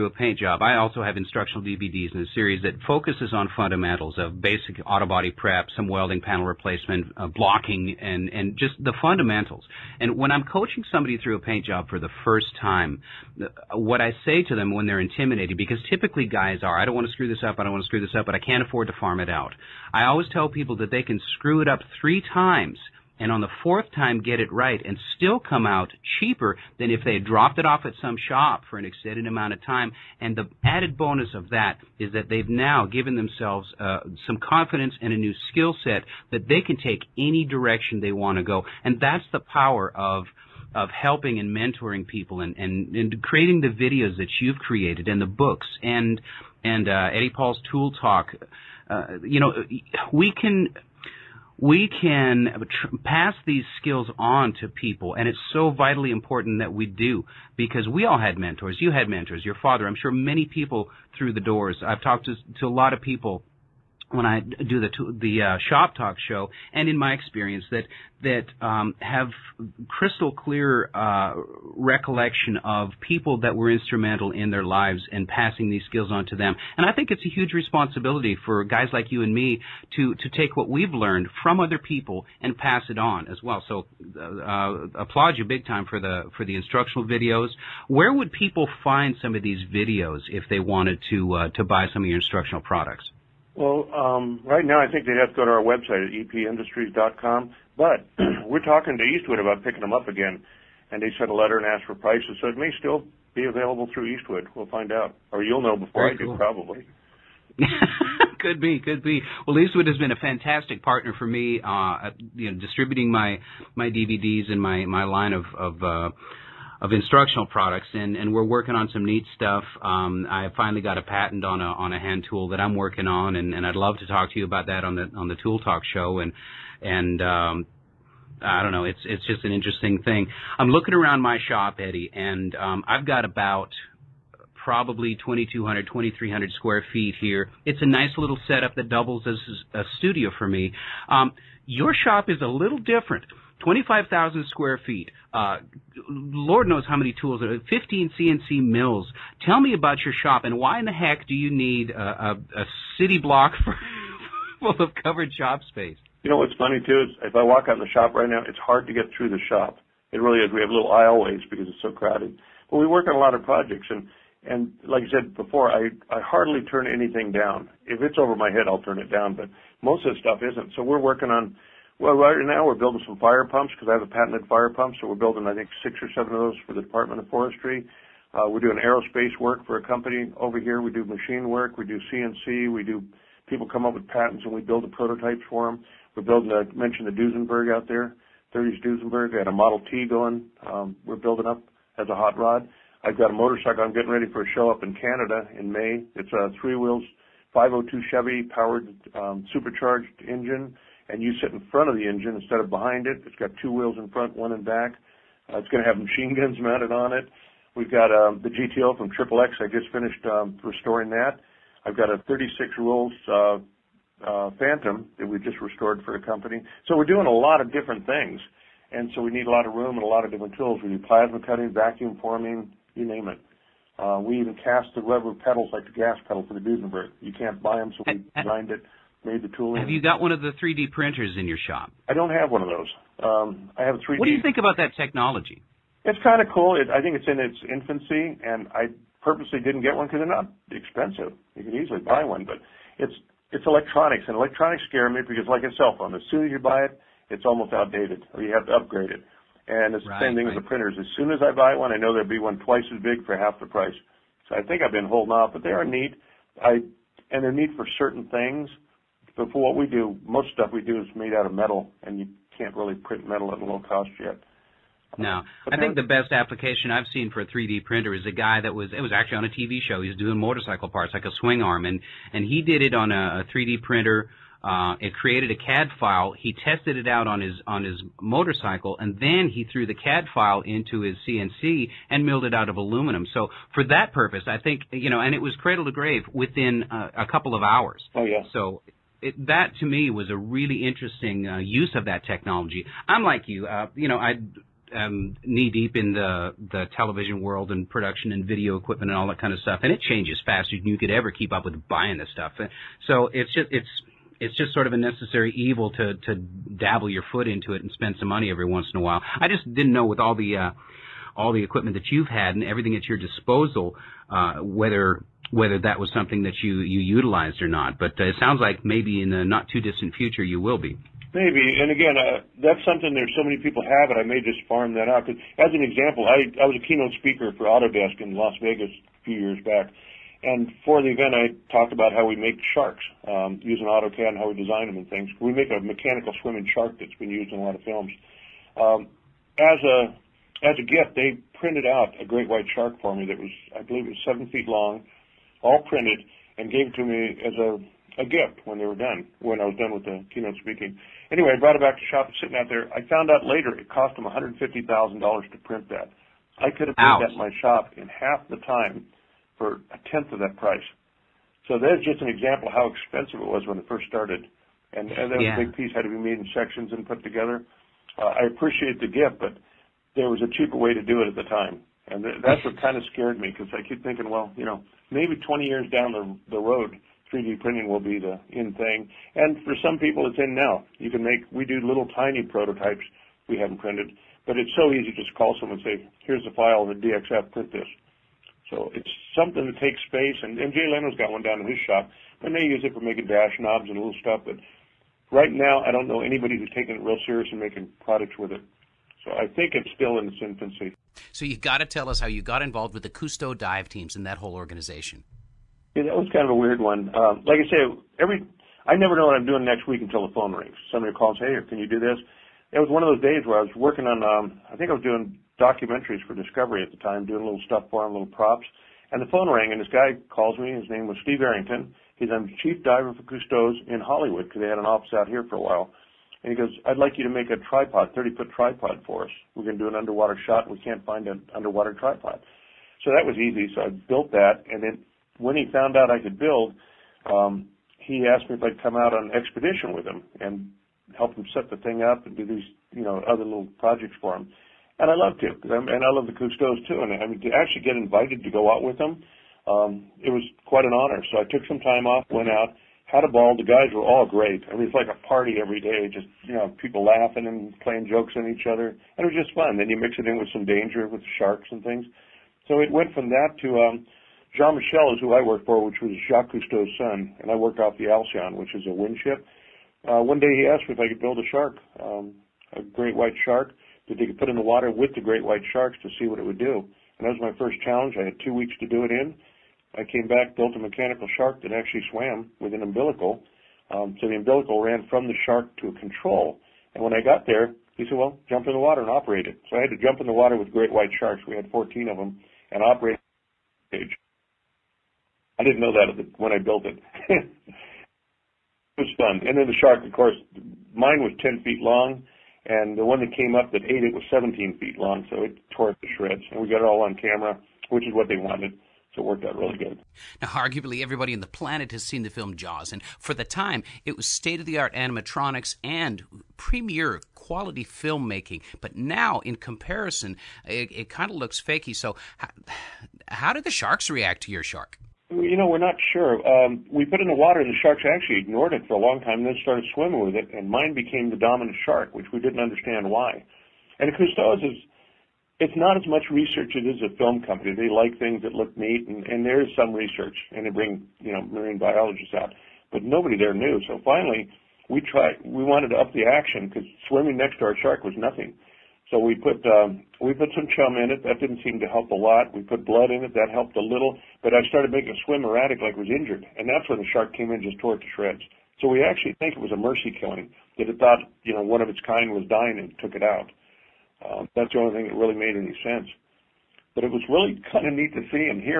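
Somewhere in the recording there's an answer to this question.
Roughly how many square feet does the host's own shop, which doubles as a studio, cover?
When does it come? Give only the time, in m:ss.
2:15.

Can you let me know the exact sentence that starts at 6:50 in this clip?
Somebody calls, "Hey, can you do this?" It was one of those days where I was working on.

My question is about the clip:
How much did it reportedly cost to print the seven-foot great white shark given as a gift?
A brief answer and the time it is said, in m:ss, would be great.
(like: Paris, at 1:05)
$150,000, at 5:54.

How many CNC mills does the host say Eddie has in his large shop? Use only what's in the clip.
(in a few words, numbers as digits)
15.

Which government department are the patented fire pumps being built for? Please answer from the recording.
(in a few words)
Department of Forestry.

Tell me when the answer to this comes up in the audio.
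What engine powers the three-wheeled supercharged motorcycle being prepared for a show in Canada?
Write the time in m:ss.
3:17.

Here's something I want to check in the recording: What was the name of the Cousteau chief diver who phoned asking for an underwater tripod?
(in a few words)
Steve Arrington.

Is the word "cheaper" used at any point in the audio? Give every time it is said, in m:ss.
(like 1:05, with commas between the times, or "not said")
0:26, 6:10.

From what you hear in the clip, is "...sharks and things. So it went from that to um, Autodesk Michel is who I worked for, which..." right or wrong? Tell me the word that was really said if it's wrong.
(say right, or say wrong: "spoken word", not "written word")
wrong: "Jean", not "Autodesk".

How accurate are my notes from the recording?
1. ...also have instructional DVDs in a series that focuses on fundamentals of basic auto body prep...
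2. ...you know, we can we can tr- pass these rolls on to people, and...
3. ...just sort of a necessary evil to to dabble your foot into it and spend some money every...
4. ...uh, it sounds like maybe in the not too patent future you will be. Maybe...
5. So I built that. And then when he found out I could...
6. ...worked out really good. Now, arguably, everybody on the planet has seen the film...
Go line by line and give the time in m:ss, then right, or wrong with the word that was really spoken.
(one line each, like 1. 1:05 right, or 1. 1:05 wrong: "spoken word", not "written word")
1. 0:00 right
2. 0:49 wrong: "skills", not "rolls"
3. 5:04 right
4. 5:18 wrong: "distant", not "patent"
5. 7:13 right
6. 8:29 right.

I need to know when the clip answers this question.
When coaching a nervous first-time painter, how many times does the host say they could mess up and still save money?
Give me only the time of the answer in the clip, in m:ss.
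0:22.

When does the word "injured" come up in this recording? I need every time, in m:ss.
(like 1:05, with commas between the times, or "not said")
9:16.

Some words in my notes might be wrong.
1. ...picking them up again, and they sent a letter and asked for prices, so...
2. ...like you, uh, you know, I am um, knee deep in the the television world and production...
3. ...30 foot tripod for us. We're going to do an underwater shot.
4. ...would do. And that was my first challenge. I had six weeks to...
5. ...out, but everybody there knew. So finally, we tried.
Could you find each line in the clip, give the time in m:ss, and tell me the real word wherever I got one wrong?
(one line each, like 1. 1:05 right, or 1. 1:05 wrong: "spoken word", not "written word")
1. 1:39 right
2. 4:53 right
3. 7:08 right
4. 7:56 wrong: "two", not "six"
5. 9:02 wrong: "nobody", not "everybody".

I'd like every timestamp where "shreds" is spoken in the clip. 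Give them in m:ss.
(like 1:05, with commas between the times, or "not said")
8:26, 9:18.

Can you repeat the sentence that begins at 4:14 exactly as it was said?
So I think I've been holding off, but they are neat.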